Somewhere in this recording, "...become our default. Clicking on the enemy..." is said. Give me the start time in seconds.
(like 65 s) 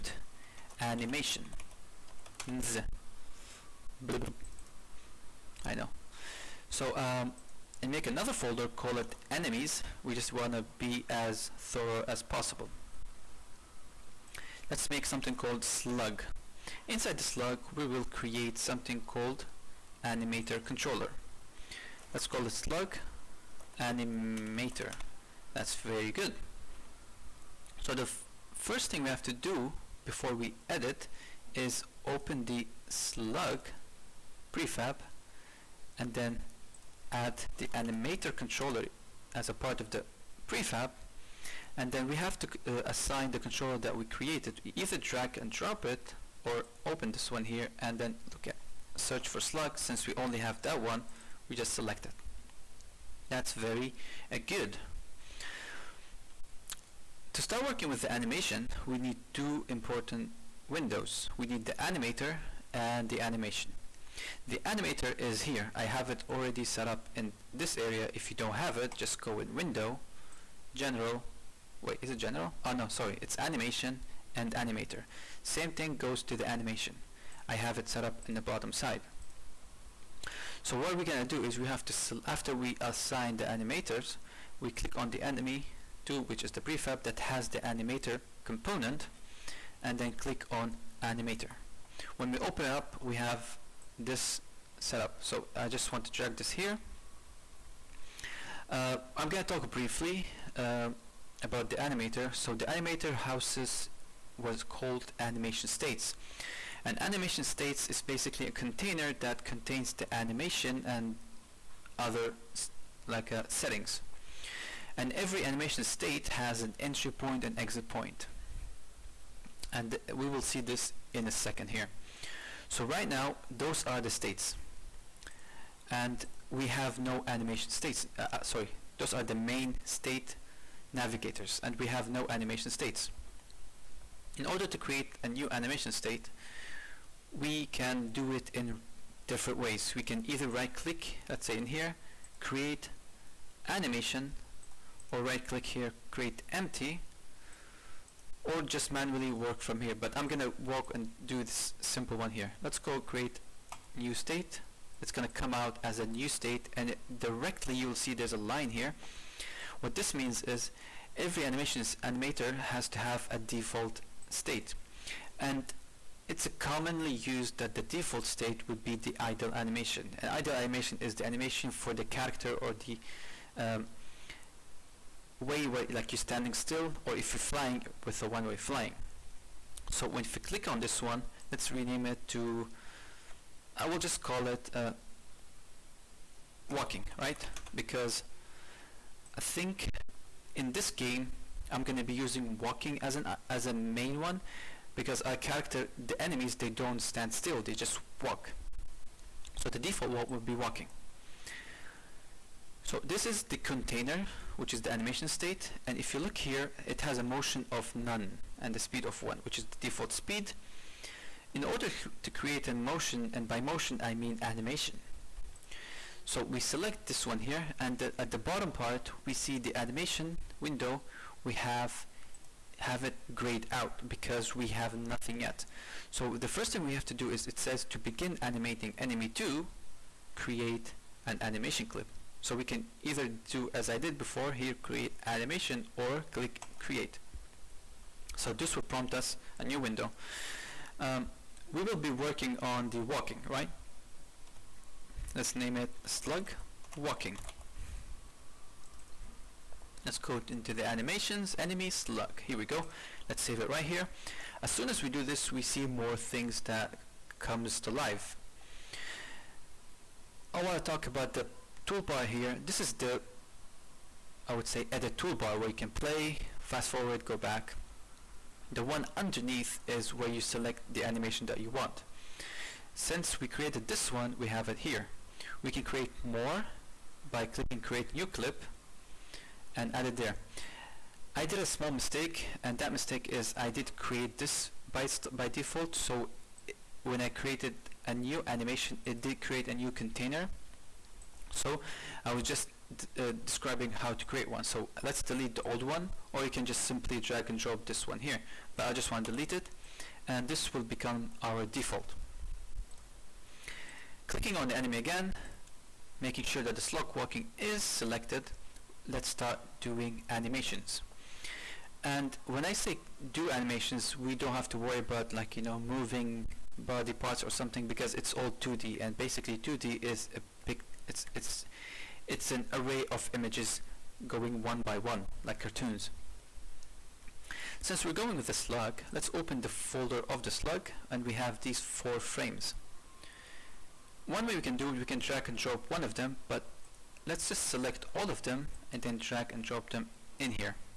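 300 s.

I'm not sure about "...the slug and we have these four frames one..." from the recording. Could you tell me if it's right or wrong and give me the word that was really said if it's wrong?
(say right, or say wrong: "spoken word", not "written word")
right.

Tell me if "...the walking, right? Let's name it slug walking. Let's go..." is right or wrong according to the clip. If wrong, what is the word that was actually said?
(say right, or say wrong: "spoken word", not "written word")
right.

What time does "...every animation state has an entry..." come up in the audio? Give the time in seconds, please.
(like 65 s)
115 s.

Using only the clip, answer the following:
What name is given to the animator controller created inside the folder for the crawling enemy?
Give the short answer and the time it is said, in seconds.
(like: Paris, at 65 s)
slug animator, at 22 s.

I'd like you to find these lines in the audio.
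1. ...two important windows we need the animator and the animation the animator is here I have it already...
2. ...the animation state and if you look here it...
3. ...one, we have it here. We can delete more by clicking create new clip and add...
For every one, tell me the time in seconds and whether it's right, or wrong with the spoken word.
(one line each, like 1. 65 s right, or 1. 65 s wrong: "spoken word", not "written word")
1. 59 s right
2. 204 s right
3. 274 s wrong: "create", not "delete".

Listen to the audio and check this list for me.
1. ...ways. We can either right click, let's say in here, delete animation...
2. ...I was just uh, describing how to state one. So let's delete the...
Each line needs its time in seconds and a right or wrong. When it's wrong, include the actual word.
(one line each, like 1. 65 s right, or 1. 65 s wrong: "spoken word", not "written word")
1. 139 s wrong: "create", not "delete"
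2. 292 s wrong: "create", not "state".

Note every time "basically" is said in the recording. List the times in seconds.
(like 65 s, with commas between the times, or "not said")
108 s, 319 s.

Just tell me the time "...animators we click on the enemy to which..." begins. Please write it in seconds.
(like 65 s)
83 s.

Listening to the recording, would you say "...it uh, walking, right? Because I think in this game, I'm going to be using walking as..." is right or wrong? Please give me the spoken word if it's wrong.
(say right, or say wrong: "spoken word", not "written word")
right.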